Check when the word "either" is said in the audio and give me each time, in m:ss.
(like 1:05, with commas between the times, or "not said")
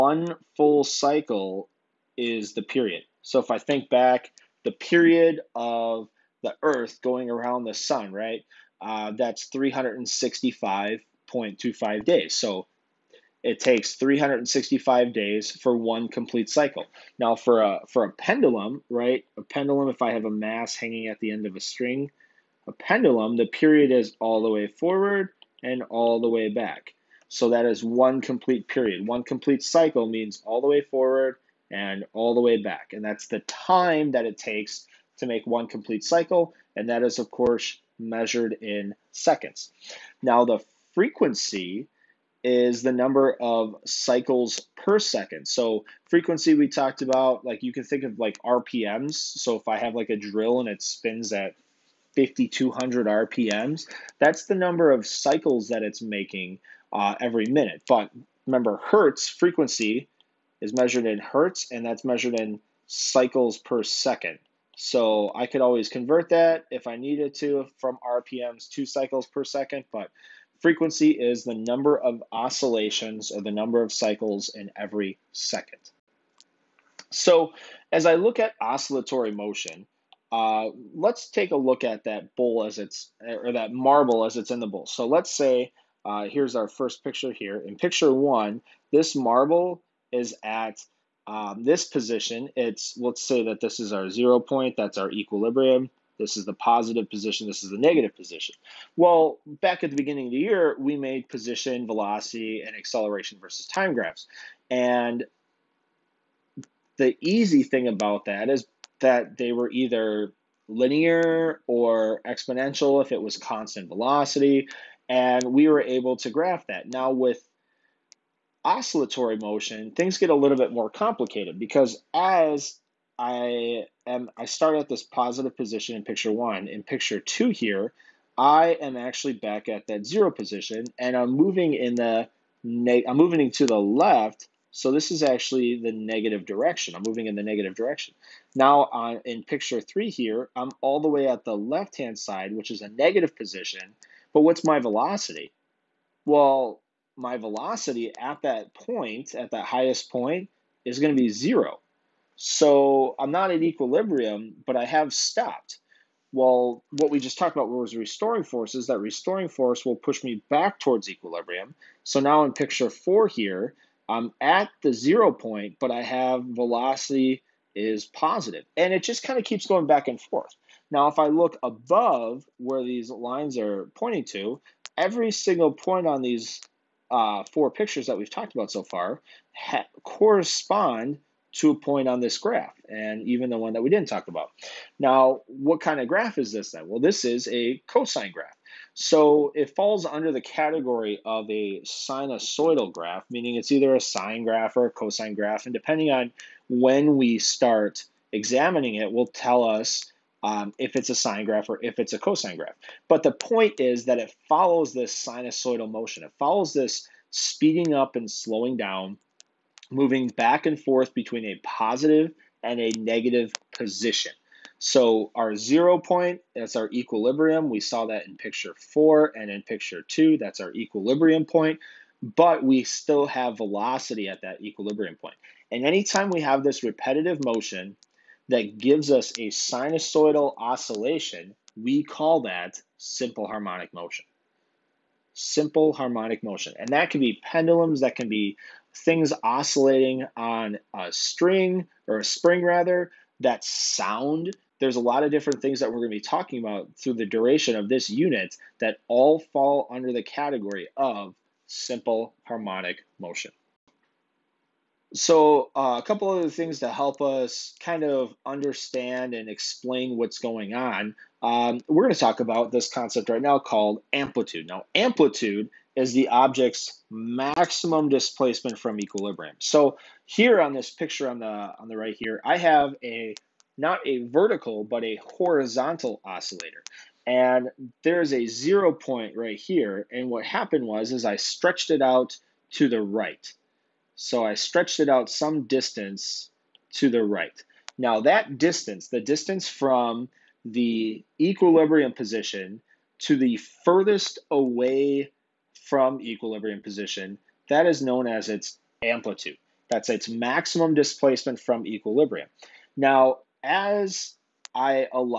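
1:49, 3:13.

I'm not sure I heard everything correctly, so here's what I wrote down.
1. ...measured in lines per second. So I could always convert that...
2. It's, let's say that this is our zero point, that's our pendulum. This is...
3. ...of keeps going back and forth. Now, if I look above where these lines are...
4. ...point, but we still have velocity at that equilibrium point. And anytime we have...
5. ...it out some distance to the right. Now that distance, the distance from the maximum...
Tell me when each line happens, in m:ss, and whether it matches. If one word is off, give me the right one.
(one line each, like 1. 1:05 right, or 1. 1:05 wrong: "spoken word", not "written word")
1. 1:02 wrong: "cycles", not "lines"
2. 1:32 wrong: "equilibrium", not "pendulum"
3. 2:49 right
4. 3:41 right
5. 4:44 wrong: "equilibrium", not "maximum".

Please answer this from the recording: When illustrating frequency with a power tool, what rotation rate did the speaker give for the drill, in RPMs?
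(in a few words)
5200.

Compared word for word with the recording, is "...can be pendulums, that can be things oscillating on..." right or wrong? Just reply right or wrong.
right.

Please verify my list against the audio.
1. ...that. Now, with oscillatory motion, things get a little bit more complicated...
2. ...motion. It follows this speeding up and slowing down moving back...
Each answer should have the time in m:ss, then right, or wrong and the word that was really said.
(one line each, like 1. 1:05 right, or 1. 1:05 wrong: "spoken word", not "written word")
1. 1:56 right
2. 3:25 right.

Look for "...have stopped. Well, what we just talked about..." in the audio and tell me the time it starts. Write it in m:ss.
2:34.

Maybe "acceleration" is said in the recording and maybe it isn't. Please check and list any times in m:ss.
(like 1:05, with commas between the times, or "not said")
1:42.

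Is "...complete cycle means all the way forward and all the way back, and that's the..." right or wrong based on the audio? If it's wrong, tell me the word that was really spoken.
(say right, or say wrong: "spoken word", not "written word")
right.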